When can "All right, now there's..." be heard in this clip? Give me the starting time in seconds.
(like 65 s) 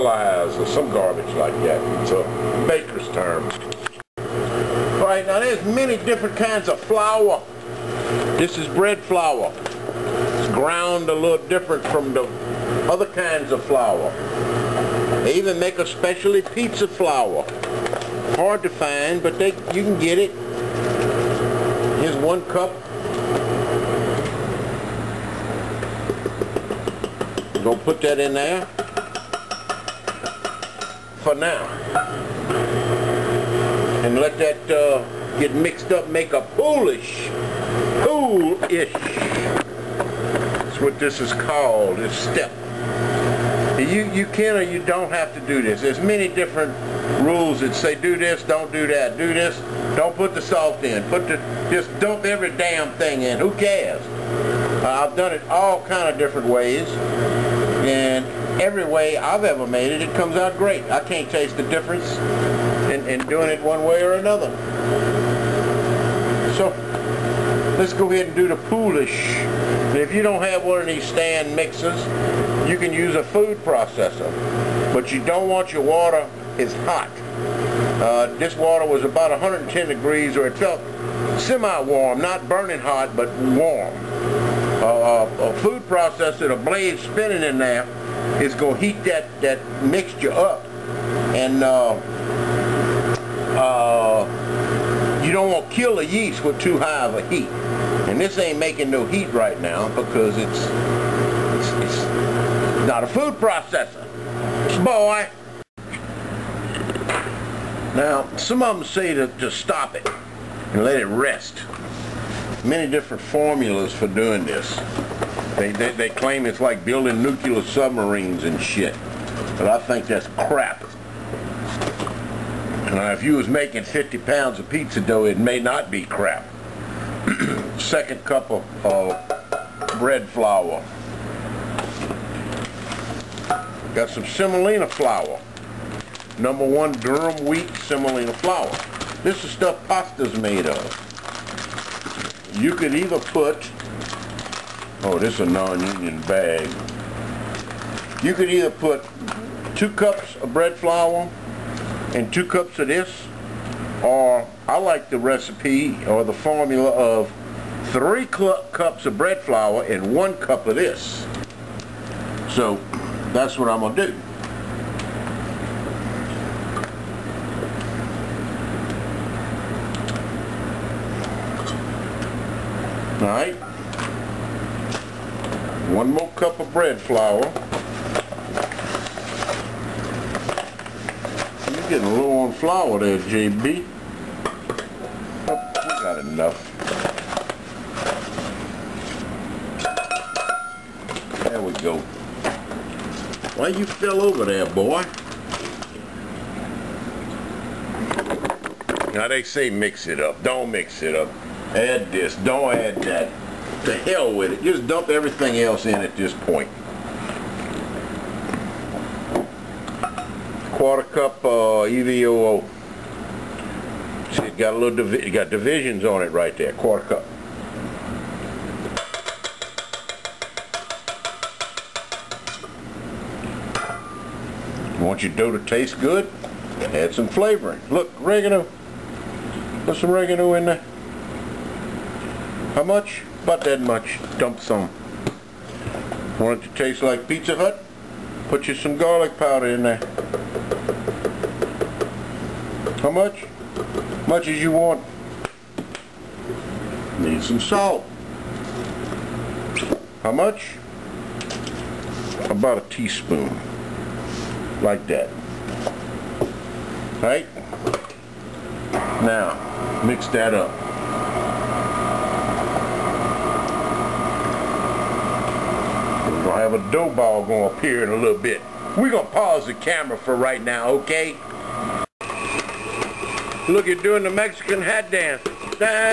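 4 s.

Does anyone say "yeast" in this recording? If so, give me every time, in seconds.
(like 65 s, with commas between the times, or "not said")
96 s.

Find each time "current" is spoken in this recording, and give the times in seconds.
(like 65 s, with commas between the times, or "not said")
not said.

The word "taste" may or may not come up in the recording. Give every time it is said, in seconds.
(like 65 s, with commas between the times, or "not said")
61 s, 225 s, 236 s.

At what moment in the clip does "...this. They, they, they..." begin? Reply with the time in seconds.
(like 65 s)
114 s.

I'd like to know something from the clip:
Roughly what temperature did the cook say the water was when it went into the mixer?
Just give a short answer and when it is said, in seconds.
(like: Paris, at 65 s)
110 degrees, at 79 s.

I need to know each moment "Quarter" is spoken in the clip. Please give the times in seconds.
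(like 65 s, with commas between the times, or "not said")
210 s, 216 s.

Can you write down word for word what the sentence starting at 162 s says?
So that's what I'm going to do.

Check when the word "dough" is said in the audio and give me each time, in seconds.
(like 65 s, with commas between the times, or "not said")
124 s, 225 s, 266 s.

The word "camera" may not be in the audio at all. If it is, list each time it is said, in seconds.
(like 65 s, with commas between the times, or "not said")
269 s.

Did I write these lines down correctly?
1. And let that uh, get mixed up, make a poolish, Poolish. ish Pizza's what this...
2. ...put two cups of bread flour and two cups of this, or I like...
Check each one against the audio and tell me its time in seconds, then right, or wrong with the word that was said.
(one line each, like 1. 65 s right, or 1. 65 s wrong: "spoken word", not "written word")
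1. 34 s wrong: "That", not "Pizza"
2. 148 s right.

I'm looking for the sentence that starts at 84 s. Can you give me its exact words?
Uh, uh a food processor, a blade spinning in there, is going to heat that, that mixture up.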